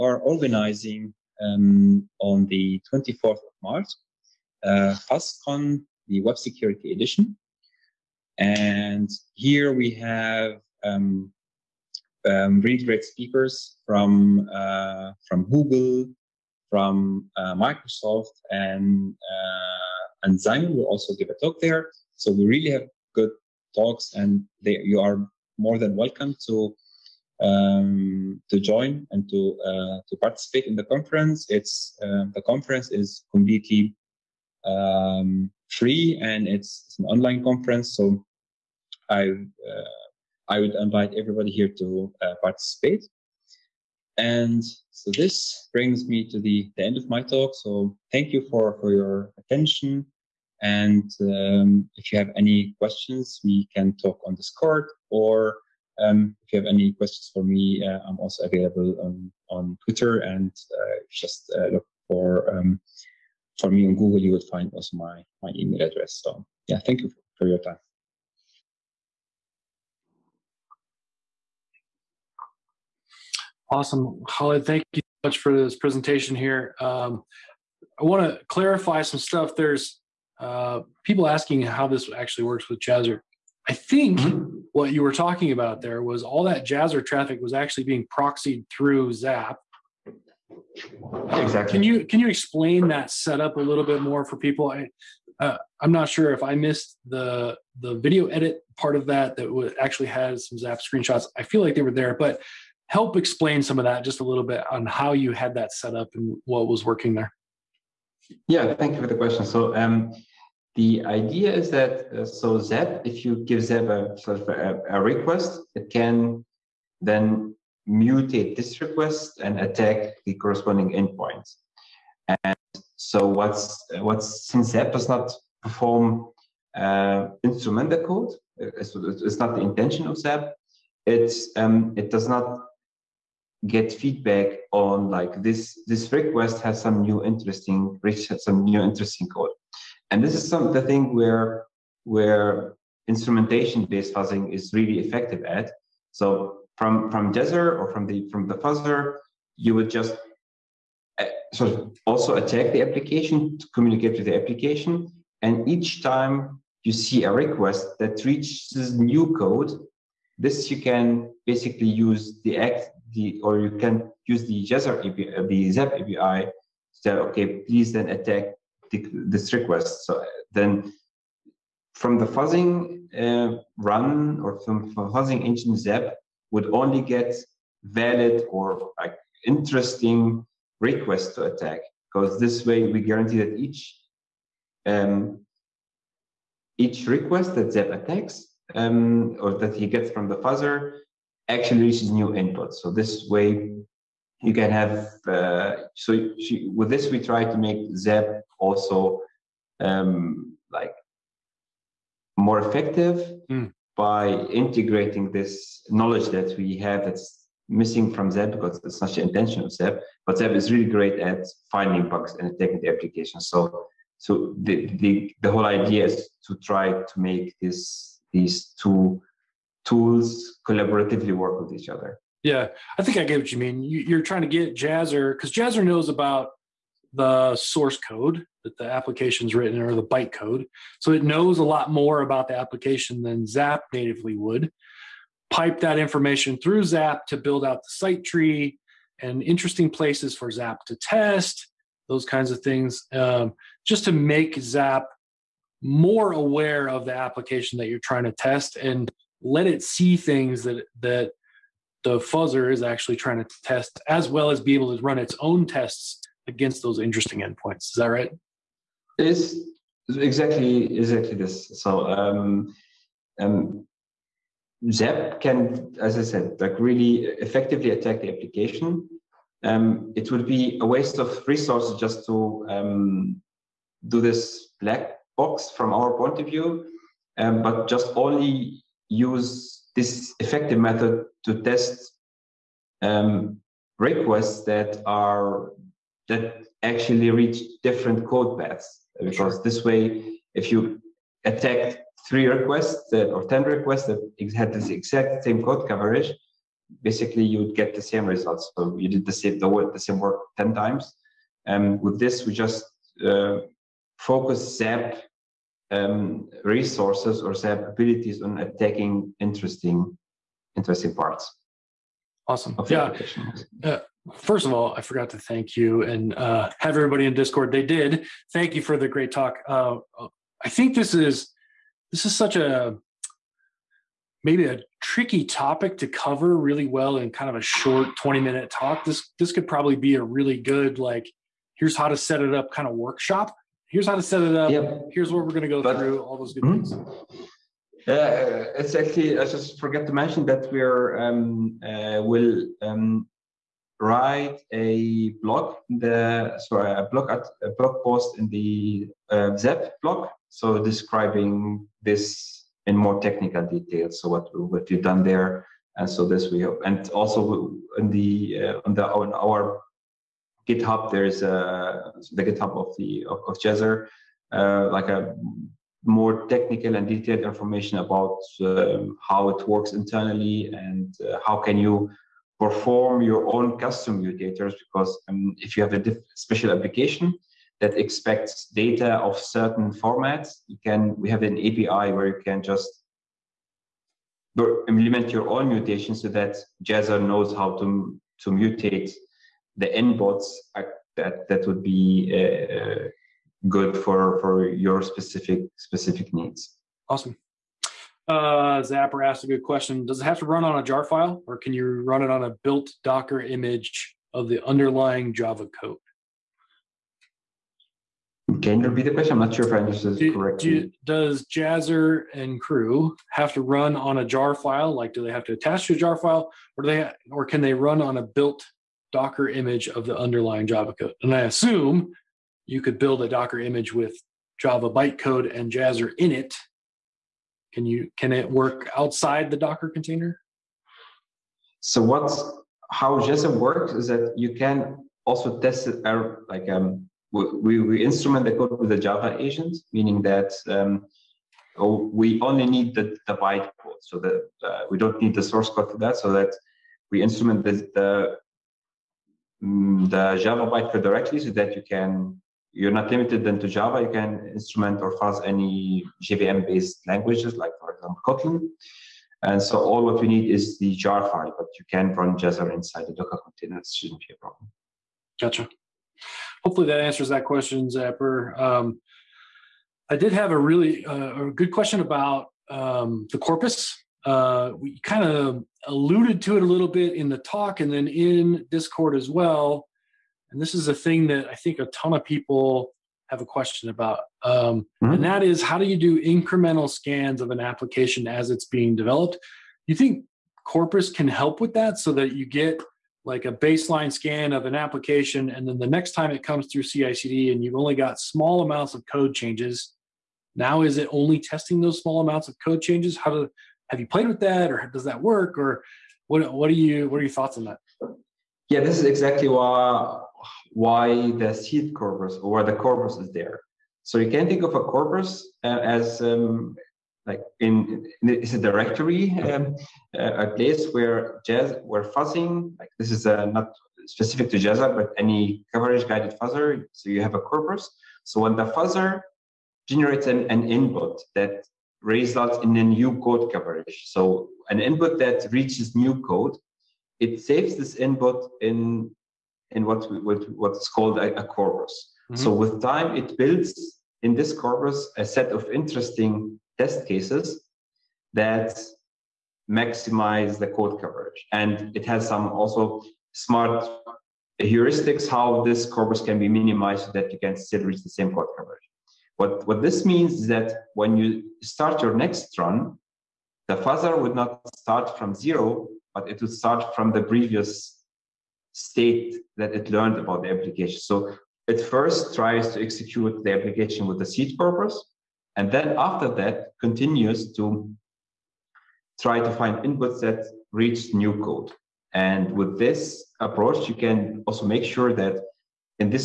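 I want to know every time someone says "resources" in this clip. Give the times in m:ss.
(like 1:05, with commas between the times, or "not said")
4:31, 5:06.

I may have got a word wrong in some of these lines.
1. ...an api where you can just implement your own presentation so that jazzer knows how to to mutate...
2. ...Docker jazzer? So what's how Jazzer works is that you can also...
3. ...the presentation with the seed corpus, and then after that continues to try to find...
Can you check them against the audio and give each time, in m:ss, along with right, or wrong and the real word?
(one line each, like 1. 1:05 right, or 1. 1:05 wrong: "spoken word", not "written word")
1. 6:21 wrong: "mutation", not "presentation"
2. 7:09 wrong: "container", not "jazzer"
3. 9:33 wrong: "application", not "presentation".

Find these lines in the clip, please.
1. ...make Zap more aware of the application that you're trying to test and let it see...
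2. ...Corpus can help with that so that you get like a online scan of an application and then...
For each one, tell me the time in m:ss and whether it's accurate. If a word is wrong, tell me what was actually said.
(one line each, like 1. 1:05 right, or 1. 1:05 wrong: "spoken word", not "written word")
1. 4:04 right
2. 8:10 wrong: "baseline", not "online".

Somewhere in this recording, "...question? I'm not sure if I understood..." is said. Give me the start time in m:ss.
6:49.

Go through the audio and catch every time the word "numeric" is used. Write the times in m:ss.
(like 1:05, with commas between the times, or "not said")
not said.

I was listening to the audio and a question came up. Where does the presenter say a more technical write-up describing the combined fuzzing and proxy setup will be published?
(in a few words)
ZAP blog.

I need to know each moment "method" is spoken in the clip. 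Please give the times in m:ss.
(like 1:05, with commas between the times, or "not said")
4:40.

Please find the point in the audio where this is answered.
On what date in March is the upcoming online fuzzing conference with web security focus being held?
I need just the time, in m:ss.
0:02.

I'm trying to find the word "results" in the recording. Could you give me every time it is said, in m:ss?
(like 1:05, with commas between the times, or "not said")
4:58, 8:52.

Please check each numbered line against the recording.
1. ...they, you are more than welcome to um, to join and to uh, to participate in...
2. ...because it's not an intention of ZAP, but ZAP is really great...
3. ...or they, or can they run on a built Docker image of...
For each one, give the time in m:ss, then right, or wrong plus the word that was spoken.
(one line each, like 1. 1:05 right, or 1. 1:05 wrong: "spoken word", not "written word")
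1. 0:24 right
2. 3:28 right
3. 6:56 right.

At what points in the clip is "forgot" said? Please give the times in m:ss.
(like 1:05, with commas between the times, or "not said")
5:15, 5:39.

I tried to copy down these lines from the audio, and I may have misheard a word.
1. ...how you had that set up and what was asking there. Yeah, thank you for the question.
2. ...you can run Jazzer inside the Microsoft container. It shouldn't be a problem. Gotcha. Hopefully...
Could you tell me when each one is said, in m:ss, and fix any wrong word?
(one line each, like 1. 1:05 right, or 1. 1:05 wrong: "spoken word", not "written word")
1. 1:44 wrong: "working", not "asking"
2. 7:41 wrong: "Docker", not "Microsoft".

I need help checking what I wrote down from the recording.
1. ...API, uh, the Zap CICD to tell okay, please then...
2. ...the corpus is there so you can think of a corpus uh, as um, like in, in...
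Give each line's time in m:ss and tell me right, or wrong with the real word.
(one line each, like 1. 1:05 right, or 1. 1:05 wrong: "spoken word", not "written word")
1. 2:45 wrong: "API", not "CICD"
2. 8:32 right.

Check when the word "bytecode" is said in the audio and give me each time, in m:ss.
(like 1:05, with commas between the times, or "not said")
3:50, 7:04, 7:23, 7:30.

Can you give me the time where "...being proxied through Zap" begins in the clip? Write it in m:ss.
1:27.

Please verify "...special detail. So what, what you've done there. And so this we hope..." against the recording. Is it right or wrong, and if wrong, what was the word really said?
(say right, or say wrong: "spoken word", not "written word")
wrong: "technical", not "special".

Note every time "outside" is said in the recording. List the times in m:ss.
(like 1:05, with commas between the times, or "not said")
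7:08.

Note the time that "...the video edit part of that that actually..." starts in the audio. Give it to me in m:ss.
1:37.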